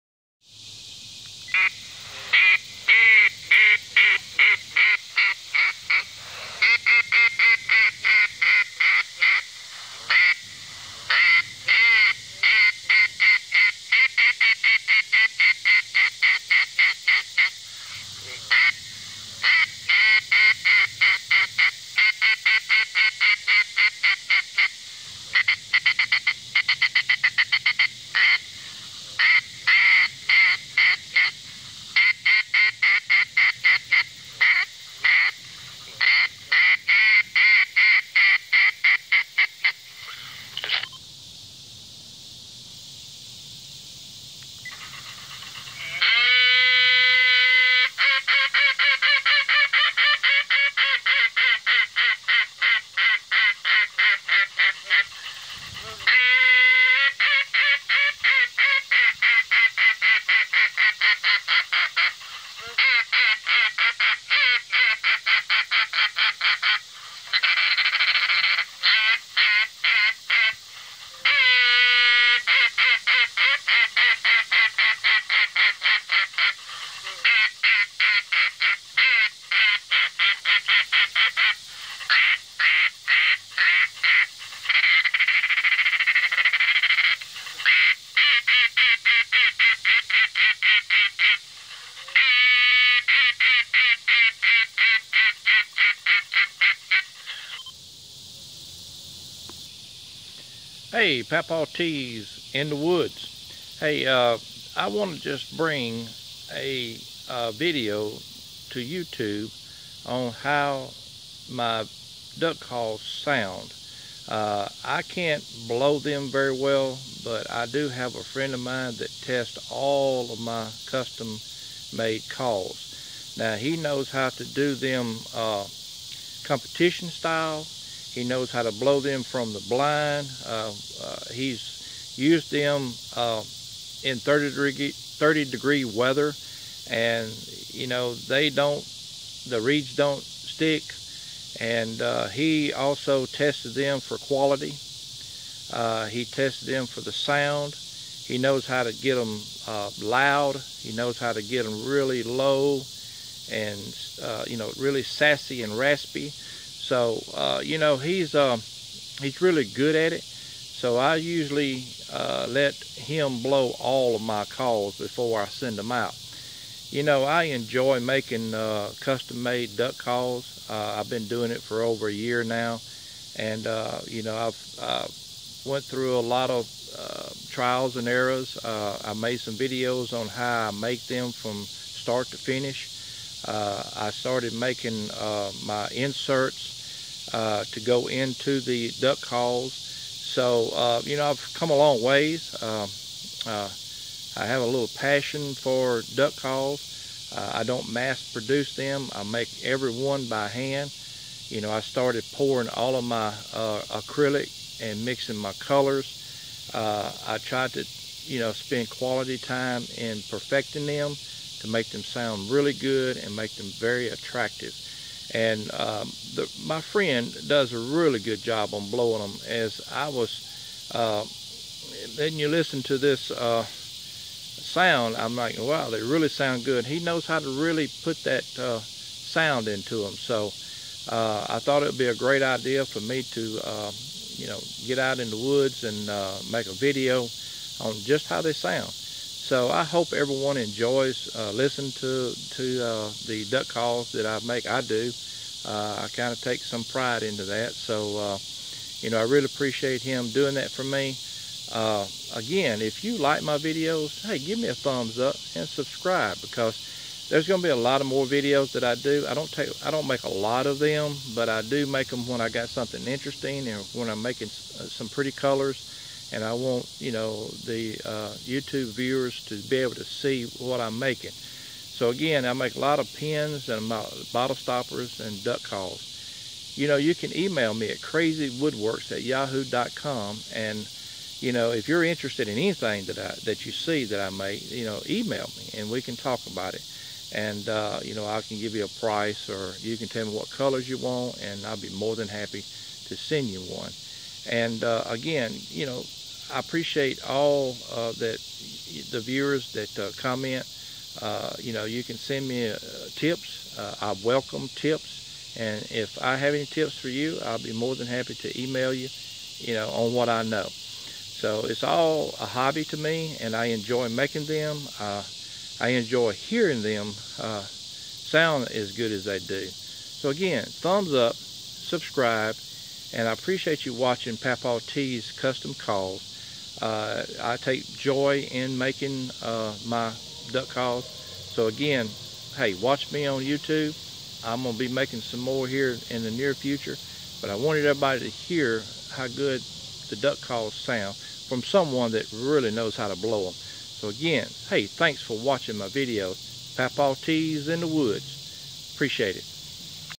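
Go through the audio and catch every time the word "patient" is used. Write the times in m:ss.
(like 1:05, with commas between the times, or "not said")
not said.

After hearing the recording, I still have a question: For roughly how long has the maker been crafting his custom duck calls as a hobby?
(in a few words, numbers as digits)
Over a year.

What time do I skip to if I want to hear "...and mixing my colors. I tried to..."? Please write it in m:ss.
3:24.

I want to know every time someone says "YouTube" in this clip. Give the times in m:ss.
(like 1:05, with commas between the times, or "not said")
1:48, 4:28, 5:33.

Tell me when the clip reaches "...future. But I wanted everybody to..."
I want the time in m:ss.
5:36.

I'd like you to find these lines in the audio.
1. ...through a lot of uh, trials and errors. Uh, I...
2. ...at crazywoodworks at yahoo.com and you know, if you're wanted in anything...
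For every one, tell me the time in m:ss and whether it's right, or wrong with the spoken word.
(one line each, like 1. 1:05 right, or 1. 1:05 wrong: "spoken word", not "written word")
1. 2:55 right
2. 4:37 wrong: "interested", not "wanted".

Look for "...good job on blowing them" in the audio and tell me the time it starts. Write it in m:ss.
3:38.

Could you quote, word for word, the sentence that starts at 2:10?
Uh, uh, he's used them uh, in 30 degree, 30 degree weather, and you know they don't, the reeds don't stick.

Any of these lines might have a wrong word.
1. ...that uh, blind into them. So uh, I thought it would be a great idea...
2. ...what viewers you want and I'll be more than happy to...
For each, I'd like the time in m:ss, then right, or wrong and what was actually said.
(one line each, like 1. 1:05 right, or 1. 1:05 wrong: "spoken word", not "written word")
1. 3:48 wrong: "sound", not "blind"
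2. 4:50 wrong: "colors", not "viewers".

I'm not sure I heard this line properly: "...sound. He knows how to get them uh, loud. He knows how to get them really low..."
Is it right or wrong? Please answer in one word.
right.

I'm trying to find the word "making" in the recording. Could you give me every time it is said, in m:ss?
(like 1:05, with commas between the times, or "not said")
2:48, 3:04, 4:24, 4:30, 5:14, 5:28, 5:34.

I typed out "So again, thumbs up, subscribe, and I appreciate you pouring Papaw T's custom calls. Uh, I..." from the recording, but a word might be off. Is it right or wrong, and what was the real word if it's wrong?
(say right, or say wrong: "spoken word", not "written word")
wrong: "watching", not "pouring".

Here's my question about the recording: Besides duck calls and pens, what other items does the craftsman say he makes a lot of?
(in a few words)
Bottle stoppers.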